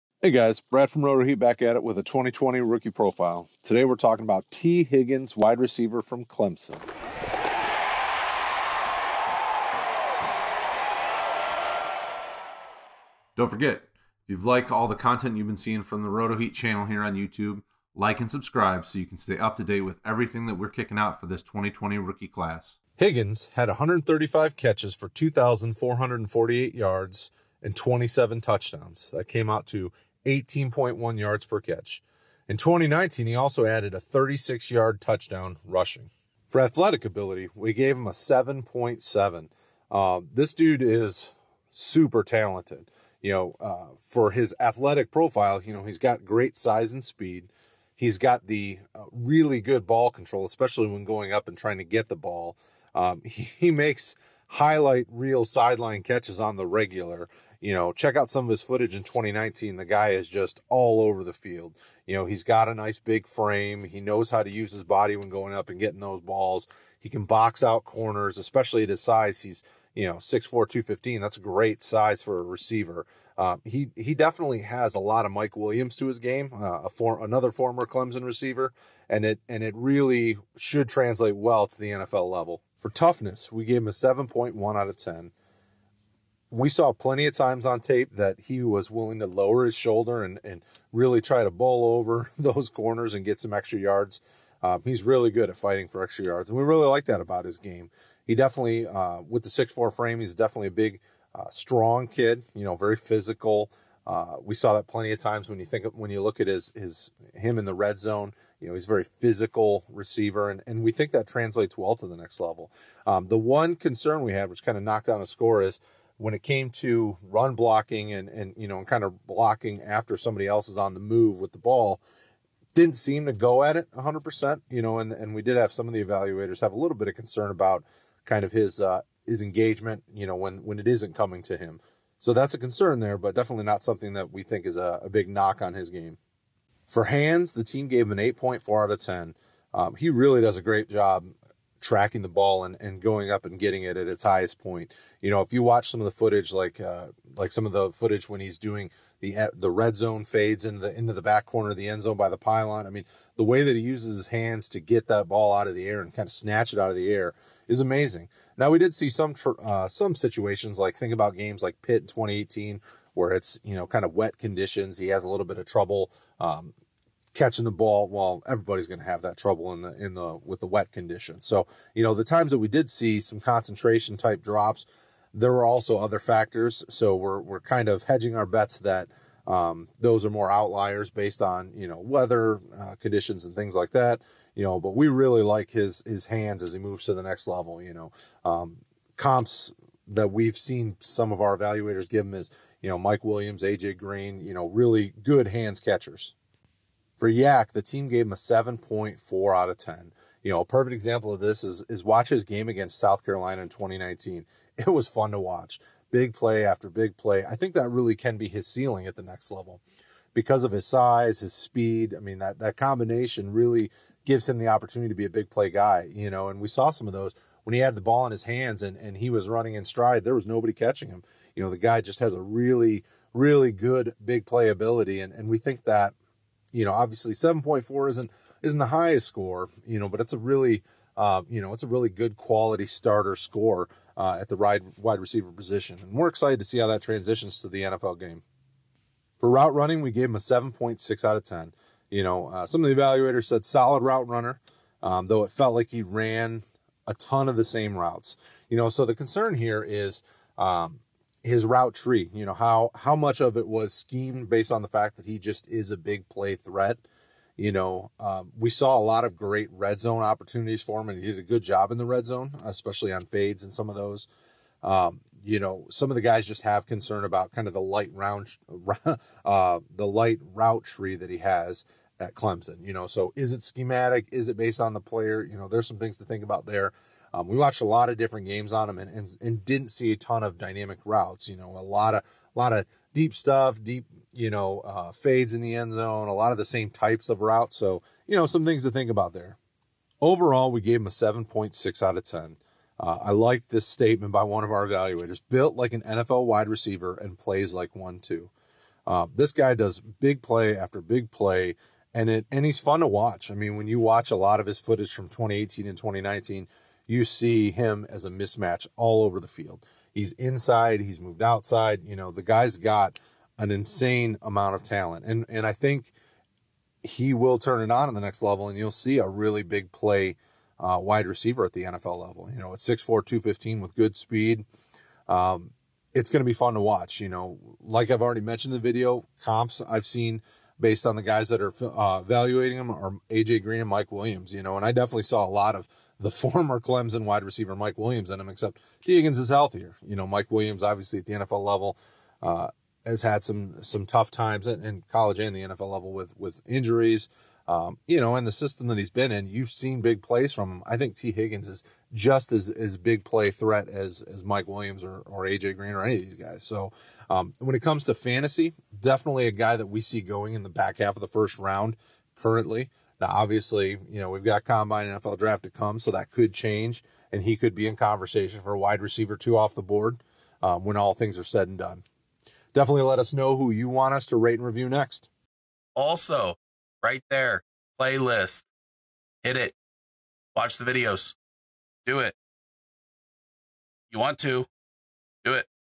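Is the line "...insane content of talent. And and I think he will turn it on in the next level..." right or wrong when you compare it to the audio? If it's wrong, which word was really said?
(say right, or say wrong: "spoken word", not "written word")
wrong: "amount", not "content".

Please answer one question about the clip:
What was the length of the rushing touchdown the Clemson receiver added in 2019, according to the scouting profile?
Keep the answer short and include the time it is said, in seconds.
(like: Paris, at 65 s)
36 yards, at 33 s.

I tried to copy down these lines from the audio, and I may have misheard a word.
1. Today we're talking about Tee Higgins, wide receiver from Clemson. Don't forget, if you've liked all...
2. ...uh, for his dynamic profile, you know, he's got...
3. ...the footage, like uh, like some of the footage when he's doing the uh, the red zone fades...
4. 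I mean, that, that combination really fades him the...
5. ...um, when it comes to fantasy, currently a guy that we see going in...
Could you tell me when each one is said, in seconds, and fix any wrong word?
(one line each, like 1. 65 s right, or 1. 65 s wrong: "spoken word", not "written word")
1. 3 s right
2. 43 s wrong: "athletic", not "dynamic"
3. 146 s right
4. 212 s wrong: "gives", not "fades"
5. 357 s wrong: "definitely", not "currently".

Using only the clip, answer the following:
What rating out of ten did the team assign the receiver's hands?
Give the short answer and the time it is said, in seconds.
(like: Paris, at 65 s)
8.4, at 138 s.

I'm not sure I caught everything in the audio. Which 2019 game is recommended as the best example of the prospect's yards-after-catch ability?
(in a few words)
South Carolina.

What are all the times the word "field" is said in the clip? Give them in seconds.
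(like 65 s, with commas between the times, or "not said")
61 s, 309 s.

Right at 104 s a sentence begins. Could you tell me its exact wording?
Uh, we saw that plenty of times when you think of, when you look at his his him in the red zone.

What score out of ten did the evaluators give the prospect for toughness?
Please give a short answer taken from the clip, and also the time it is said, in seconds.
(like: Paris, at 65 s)
7.1, at 83 s.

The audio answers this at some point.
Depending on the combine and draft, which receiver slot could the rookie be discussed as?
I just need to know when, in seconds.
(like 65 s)
368 s.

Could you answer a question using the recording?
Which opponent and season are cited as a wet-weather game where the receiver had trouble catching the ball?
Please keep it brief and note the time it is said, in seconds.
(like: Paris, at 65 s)
Pitt in 2018, at 161 s.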